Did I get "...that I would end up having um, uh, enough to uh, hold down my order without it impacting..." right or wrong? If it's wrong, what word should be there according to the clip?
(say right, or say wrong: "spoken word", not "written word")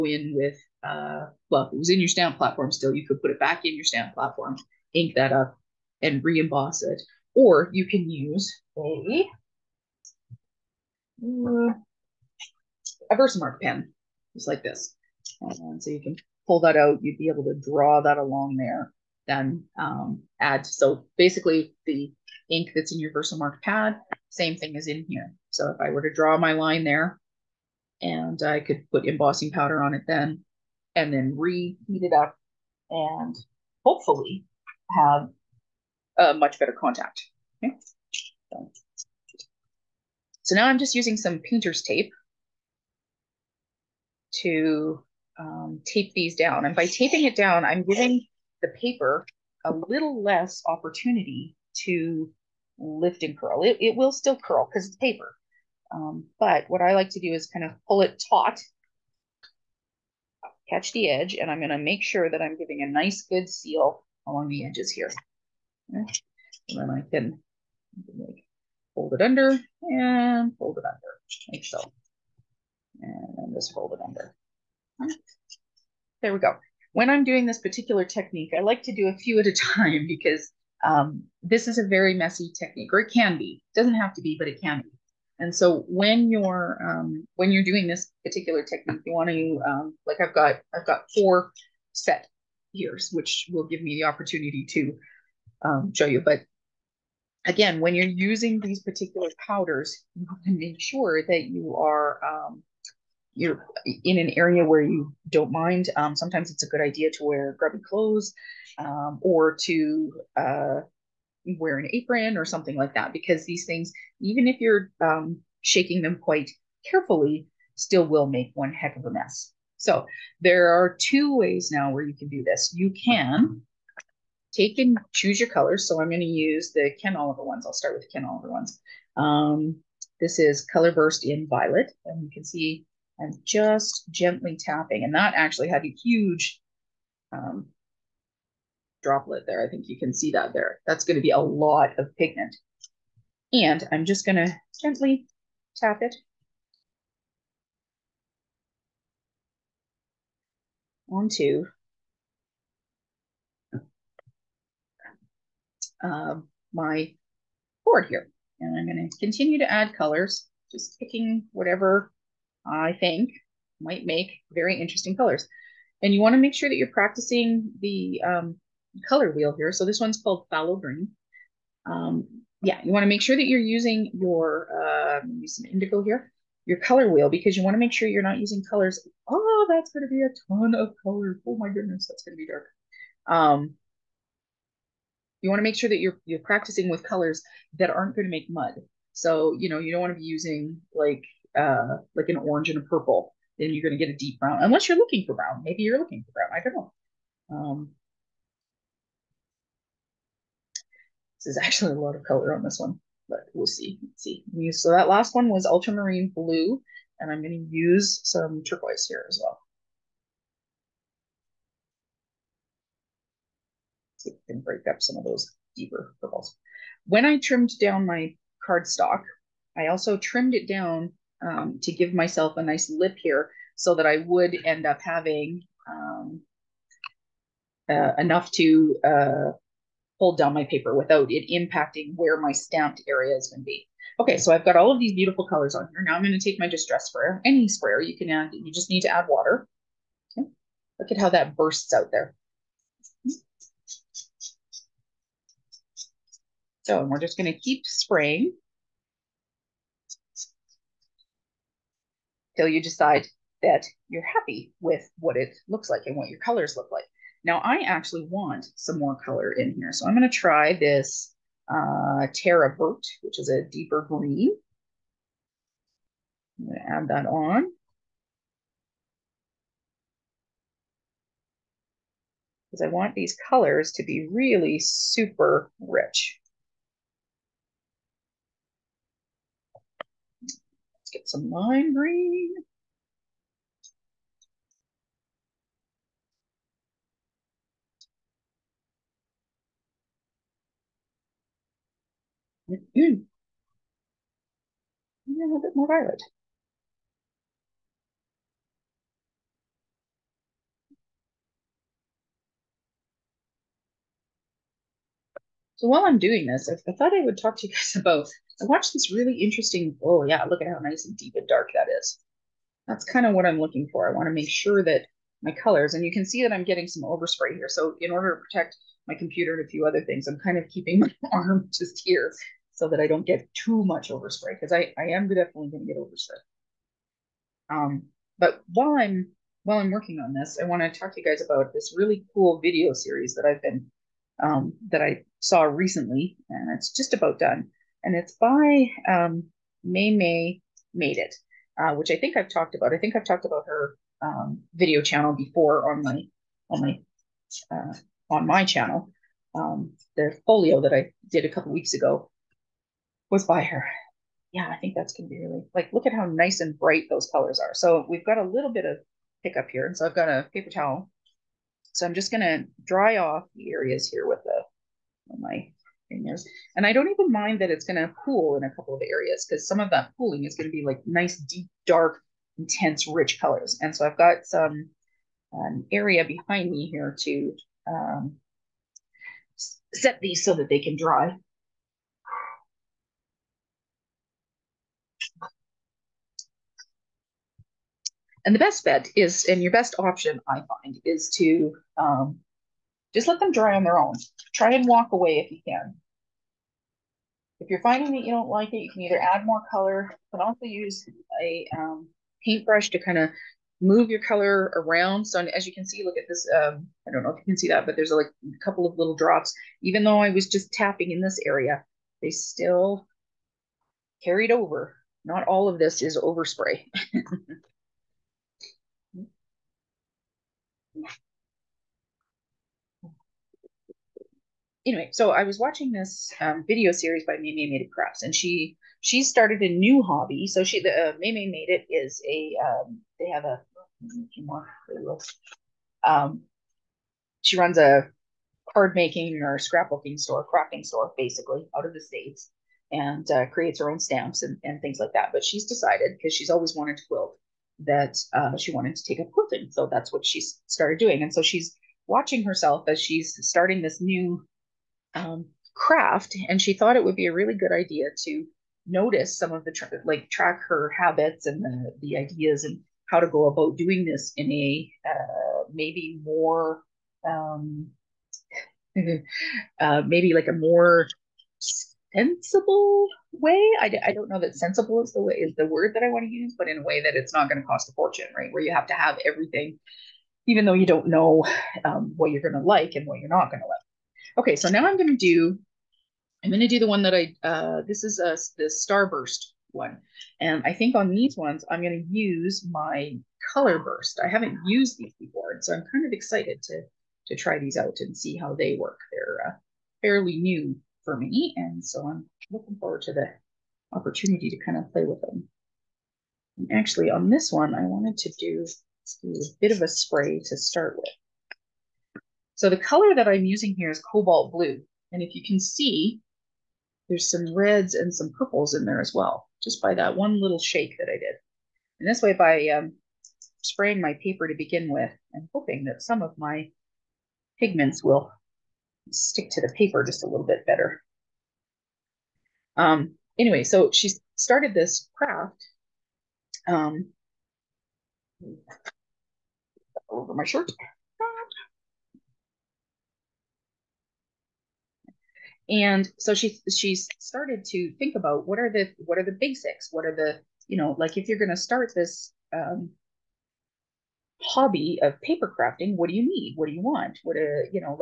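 wrong: "paper", not "order".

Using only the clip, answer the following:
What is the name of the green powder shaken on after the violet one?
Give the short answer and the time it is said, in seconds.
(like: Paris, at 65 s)
Phthalo Green, at 170 s.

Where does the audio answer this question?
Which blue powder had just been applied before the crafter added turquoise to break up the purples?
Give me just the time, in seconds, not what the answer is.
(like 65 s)
205 s.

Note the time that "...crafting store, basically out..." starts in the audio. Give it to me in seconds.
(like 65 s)
440 s.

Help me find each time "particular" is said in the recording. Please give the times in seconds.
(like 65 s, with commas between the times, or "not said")
77 s, 88 s, 98 s.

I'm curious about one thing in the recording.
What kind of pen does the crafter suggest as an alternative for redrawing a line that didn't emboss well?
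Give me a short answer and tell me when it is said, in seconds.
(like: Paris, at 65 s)
Versamark pen, at 13 s.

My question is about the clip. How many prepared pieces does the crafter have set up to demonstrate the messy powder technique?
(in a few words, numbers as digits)
4.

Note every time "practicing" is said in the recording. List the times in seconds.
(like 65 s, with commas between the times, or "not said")
166 s, 186 s.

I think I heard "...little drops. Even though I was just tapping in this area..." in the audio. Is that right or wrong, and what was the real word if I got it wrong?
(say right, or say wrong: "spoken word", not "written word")
right.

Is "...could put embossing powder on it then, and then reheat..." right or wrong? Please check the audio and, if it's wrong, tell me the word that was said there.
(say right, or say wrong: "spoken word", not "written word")
right.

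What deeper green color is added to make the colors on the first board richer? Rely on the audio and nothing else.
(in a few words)
Terra Vert.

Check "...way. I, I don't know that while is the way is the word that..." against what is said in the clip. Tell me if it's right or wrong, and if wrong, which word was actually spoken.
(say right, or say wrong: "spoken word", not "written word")
wrong: "sensible", not "while".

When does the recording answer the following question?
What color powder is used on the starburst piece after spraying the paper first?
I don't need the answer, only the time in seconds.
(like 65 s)
514 s.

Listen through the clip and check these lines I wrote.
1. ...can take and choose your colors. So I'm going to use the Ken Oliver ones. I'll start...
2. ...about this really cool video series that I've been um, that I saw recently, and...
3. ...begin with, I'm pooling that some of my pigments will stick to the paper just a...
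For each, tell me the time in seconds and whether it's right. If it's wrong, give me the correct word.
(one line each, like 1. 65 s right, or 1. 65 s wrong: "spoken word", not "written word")
1. 123 s right
2. 331 s right
3. 524 s wrong: "hoping", not "pooling".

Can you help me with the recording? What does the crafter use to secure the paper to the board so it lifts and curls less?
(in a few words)
painter's tape.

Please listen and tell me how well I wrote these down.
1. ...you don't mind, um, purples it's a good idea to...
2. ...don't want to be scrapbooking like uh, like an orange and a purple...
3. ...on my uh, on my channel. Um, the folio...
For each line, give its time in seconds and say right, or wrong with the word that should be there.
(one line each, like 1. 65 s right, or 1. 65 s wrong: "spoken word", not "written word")
1. 104 s wrong: "sometimes", not "purples"
2. 189 s wrong: "using", not "scrapbooking"
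3. 346 s right.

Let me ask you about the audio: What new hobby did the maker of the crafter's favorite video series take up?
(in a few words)
quilting.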